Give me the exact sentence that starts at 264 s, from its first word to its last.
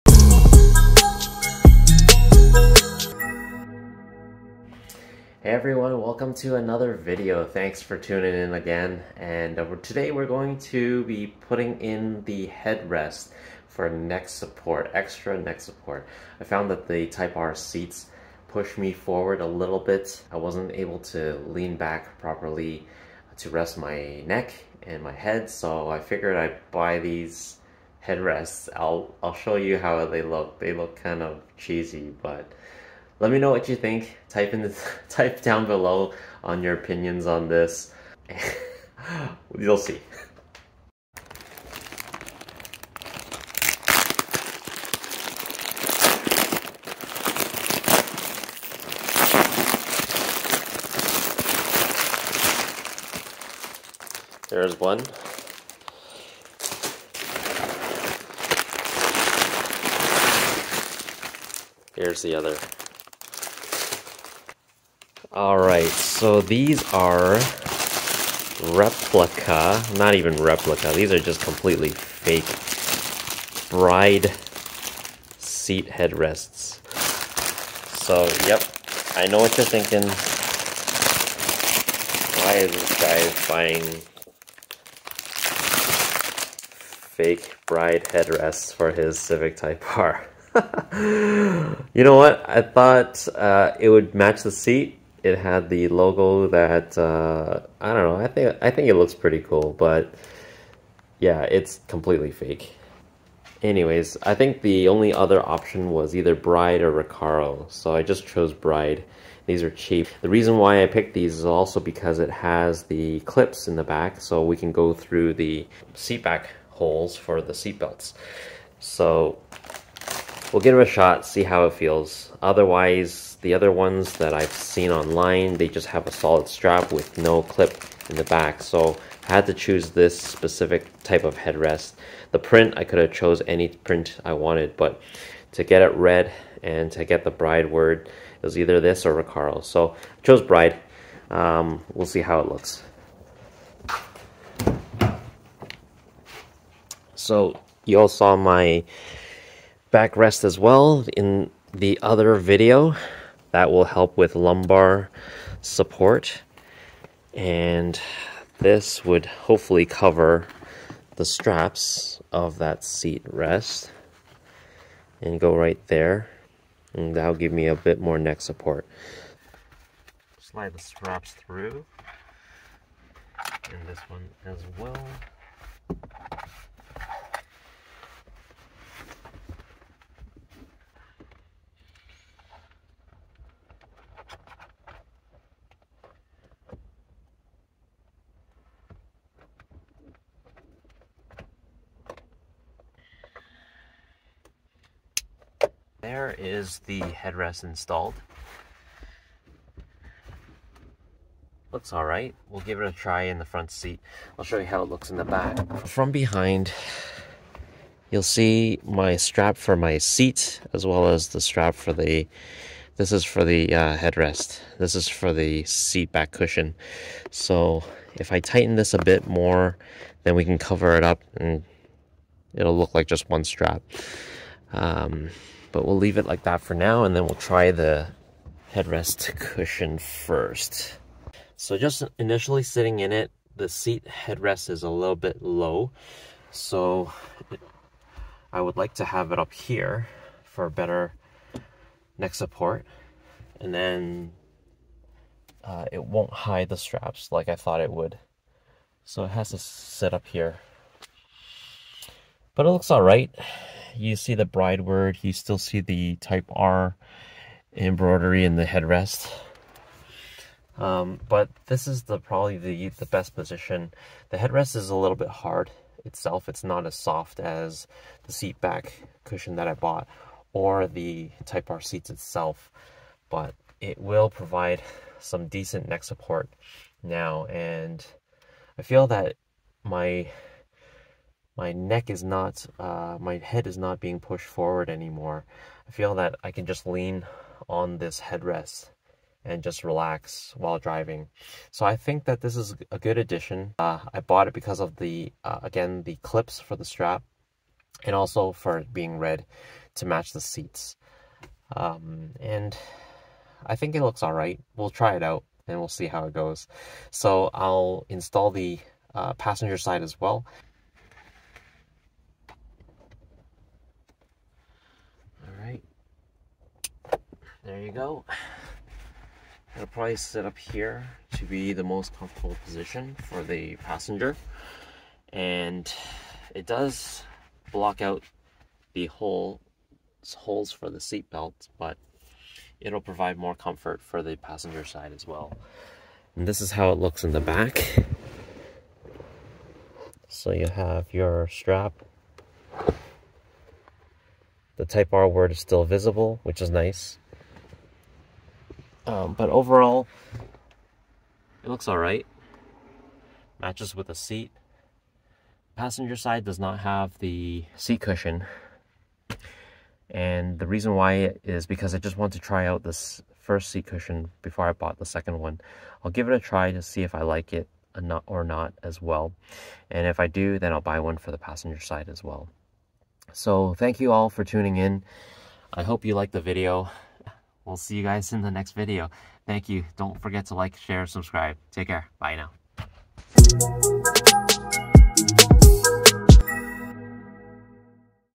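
The headrest is a little bit hard itself.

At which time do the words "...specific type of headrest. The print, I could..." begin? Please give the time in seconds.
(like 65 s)
130 s.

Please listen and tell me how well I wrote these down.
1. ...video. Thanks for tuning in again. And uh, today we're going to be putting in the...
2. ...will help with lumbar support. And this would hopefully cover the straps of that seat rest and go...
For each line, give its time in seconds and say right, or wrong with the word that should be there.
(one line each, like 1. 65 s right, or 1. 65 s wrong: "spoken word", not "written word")
1. 6 s right
2. 153 s right.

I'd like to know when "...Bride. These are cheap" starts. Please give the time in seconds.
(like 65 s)
108 s.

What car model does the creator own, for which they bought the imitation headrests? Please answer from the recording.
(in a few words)
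Civic Type R.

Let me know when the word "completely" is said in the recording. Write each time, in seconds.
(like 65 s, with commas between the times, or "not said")
71 s, 101 s.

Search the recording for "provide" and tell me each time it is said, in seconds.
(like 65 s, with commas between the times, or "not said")
274 s, 332 s.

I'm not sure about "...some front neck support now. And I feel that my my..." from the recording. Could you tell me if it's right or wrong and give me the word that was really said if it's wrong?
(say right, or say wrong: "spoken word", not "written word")
wrong: "decent", not "front".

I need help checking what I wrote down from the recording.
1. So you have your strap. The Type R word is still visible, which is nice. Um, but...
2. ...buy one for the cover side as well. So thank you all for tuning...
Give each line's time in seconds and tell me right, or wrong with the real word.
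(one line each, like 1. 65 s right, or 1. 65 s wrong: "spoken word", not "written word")
1. 340 s right
2. 370 s wrong: "passenger", not "cover".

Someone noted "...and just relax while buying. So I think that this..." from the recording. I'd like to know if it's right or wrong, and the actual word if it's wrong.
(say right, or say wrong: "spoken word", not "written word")
wrong: "driving", not "buying".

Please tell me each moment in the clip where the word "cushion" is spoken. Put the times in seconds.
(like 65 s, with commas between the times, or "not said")
216 s, 229 s, 269 s, 358 s, 363 s.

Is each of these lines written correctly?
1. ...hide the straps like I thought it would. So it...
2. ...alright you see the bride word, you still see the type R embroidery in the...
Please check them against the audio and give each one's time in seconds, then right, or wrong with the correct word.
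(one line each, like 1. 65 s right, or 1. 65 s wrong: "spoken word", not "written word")
1. 246 s right
2. 252 s right.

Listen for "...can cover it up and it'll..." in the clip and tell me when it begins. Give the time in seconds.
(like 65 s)
220 s.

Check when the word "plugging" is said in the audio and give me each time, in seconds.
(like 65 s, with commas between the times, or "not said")
not said.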